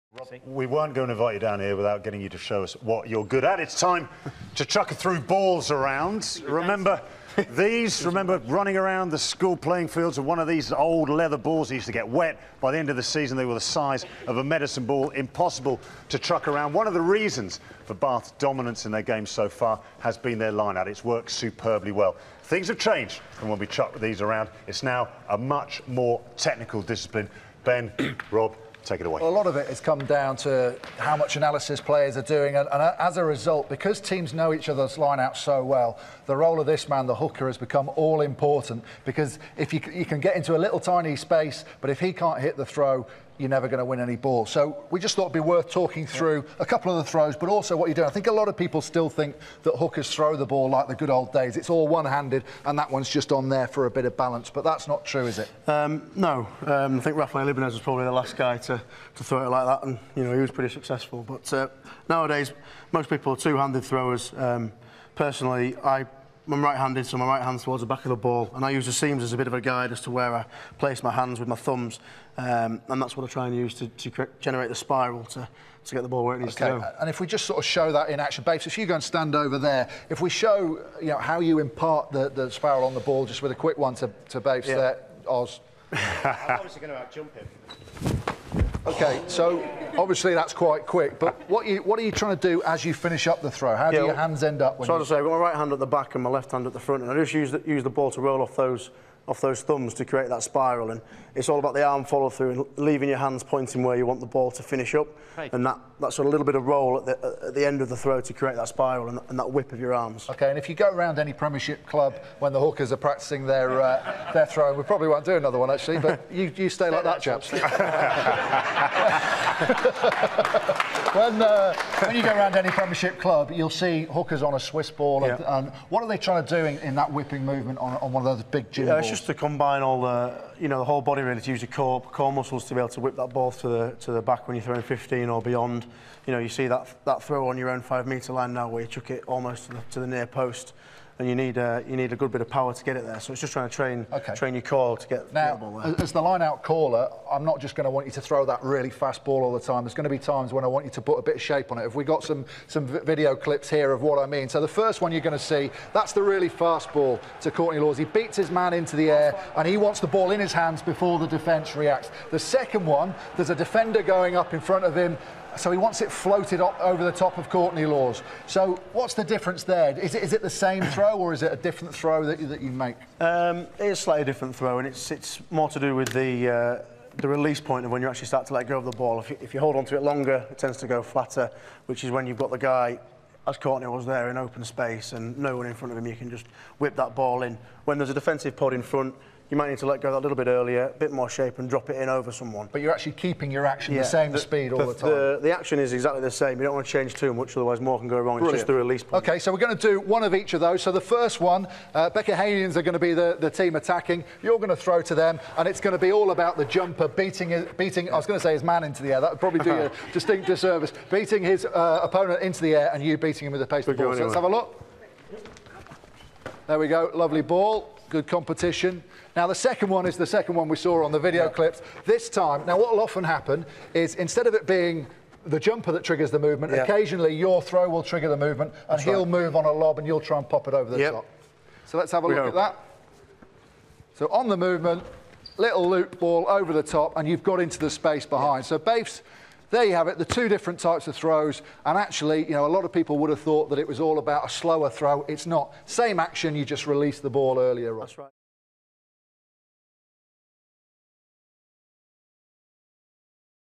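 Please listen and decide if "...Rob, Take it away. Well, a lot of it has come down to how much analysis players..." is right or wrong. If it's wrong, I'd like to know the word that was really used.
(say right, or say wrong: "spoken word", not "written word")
right.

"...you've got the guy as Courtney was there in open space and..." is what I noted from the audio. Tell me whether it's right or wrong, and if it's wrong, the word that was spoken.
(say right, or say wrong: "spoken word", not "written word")
right.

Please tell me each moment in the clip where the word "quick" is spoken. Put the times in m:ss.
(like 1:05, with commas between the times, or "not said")
1:23, 1:30.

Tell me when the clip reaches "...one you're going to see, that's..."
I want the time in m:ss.
2:35.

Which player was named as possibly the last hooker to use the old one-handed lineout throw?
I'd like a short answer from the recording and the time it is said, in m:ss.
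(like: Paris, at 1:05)
Rafael Ibanez, at 0:57.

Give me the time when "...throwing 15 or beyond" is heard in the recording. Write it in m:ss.
2:14.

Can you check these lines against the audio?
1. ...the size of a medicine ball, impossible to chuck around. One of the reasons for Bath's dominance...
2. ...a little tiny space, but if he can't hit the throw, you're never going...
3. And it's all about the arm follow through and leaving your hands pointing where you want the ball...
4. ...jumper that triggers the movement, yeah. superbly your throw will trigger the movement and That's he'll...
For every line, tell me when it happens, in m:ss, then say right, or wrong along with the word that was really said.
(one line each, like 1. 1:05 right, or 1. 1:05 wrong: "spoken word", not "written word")
1. 0:13 right
2. 0:40 right
3. 1:40 right
4. 3:45 wrong: "occasionally", not "superbly".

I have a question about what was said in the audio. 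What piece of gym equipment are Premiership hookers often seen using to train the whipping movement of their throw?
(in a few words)
Swiss ball.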